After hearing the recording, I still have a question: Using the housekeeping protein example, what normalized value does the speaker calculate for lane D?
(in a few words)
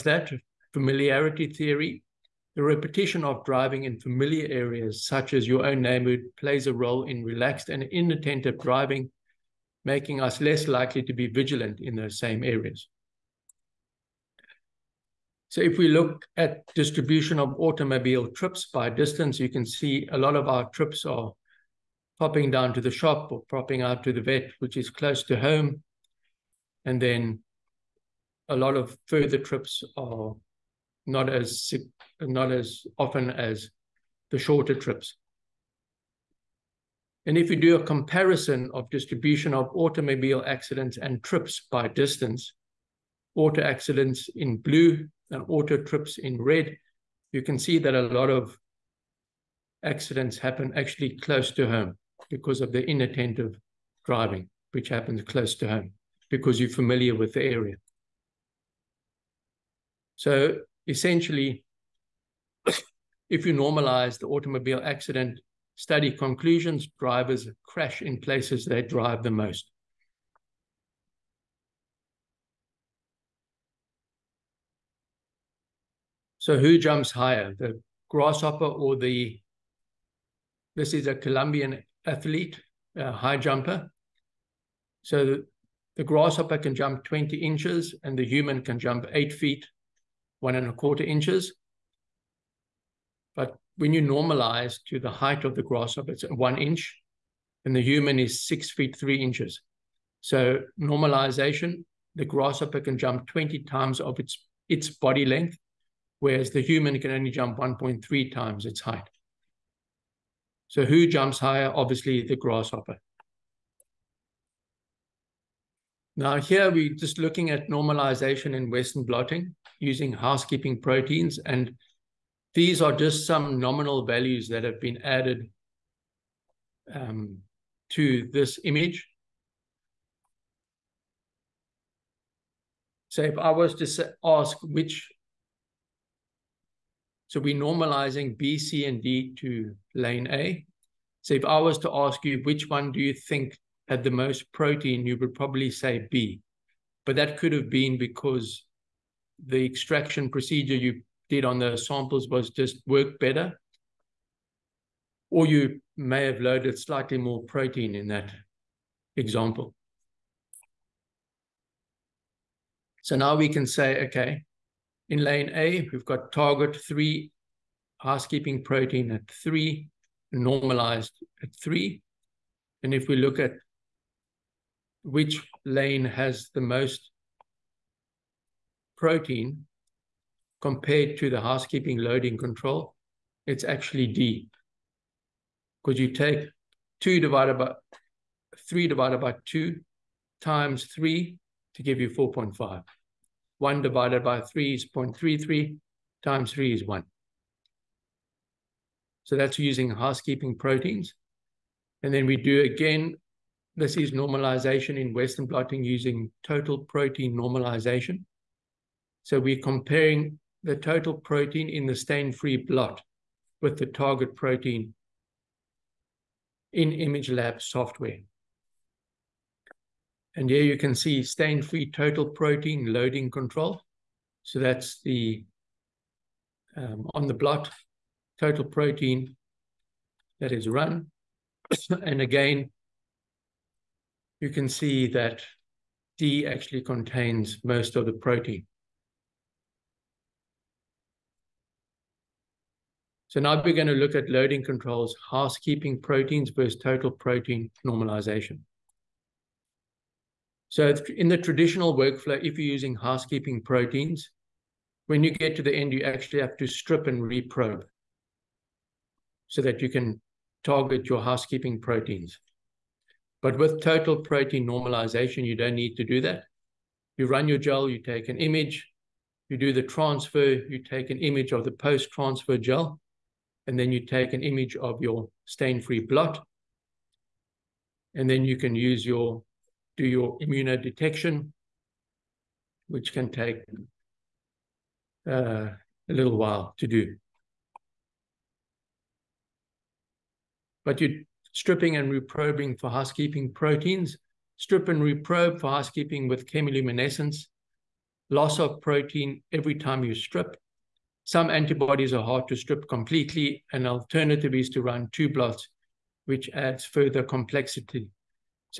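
4.5.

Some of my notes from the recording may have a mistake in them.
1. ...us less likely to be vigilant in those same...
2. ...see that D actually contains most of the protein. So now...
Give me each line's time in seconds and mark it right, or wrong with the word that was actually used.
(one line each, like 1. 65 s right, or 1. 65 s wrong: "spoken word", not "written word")
1. 10 s right
2. 234 s right.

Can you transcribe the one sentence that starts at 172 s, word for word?
And if we look at which lane has the most protein, compared to the housekeeping loading control, it's actually D.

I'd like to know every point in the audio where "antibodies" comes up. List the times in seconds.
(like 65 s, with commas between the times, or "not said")
301 s.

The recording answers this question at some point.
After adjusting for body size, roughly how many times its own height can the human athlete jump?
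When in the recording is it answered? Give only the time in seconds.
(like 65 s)
107 s.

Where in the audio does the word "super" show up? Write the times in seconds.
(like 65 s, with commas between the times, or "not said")
not said.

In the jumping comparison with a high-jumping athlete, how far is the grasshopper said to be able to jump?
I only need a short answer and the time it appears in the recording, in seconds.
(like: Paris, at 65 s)
20 inches, at 87 s.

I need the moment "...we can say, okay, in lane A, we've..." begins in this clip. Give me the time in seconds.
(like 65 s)
163 s.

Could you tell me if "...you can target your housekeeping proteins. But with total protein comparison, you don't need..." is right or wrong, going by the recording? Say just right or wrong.
wrong.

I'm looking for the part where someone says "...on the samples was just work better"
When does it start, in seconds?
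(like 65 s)
151 s.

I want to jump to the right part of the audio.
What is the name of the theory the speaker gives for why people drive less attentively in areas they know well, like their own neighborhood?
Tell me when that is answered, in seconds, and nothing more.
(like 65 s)
0 s.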